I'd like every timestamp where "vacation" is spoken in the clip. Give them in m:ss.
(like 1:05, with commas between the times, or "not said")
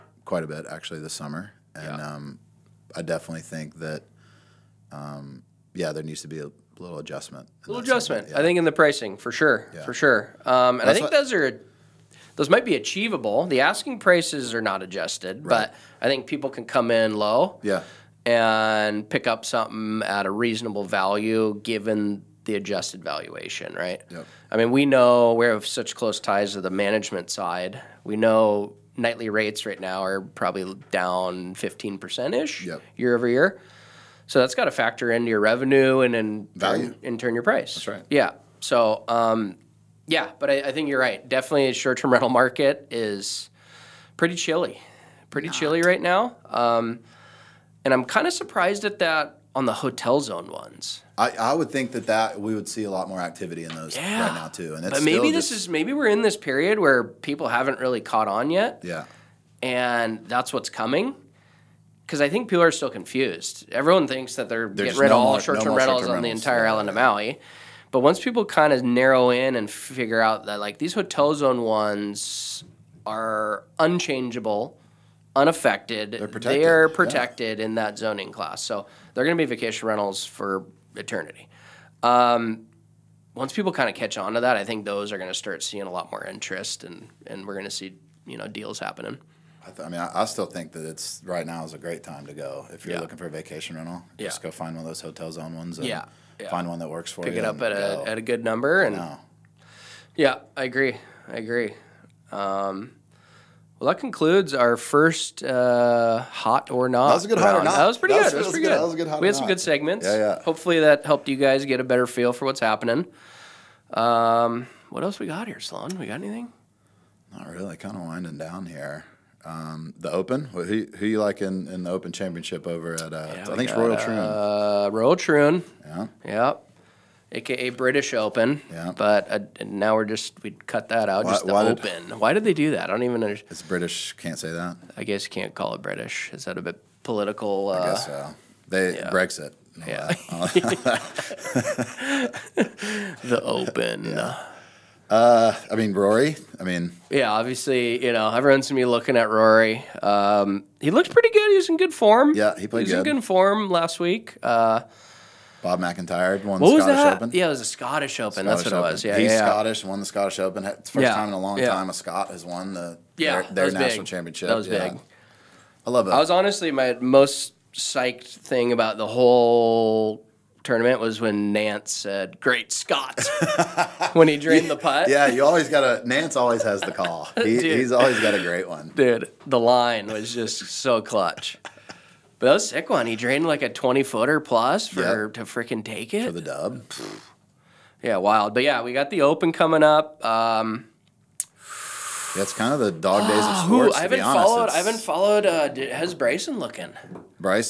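1:19, 1:33.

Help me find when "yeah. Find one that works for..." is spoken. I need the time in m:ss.
1:36.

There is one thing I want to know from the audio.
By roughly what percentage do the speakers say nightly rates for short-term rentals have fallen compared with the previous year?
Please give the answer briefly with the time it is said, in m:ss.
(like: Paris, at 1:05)
15%, at 0:31.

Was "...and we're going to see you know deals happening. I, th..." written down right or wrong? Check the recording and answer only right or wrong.
right.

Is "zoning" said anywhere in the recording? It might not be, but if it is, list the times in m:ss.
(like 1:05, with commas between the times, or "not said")
1:17.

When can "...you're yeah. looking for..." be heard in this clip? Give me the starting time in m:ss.
1:32.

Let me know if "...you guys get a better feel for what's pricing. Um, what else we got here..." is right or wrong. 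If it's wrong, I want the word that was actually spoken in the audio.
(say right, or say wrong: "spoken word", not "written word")
wrong: "happening", not "pricing".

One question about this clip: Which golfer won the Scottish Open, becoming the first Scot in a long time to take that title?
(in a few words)
Bob MacIntyre.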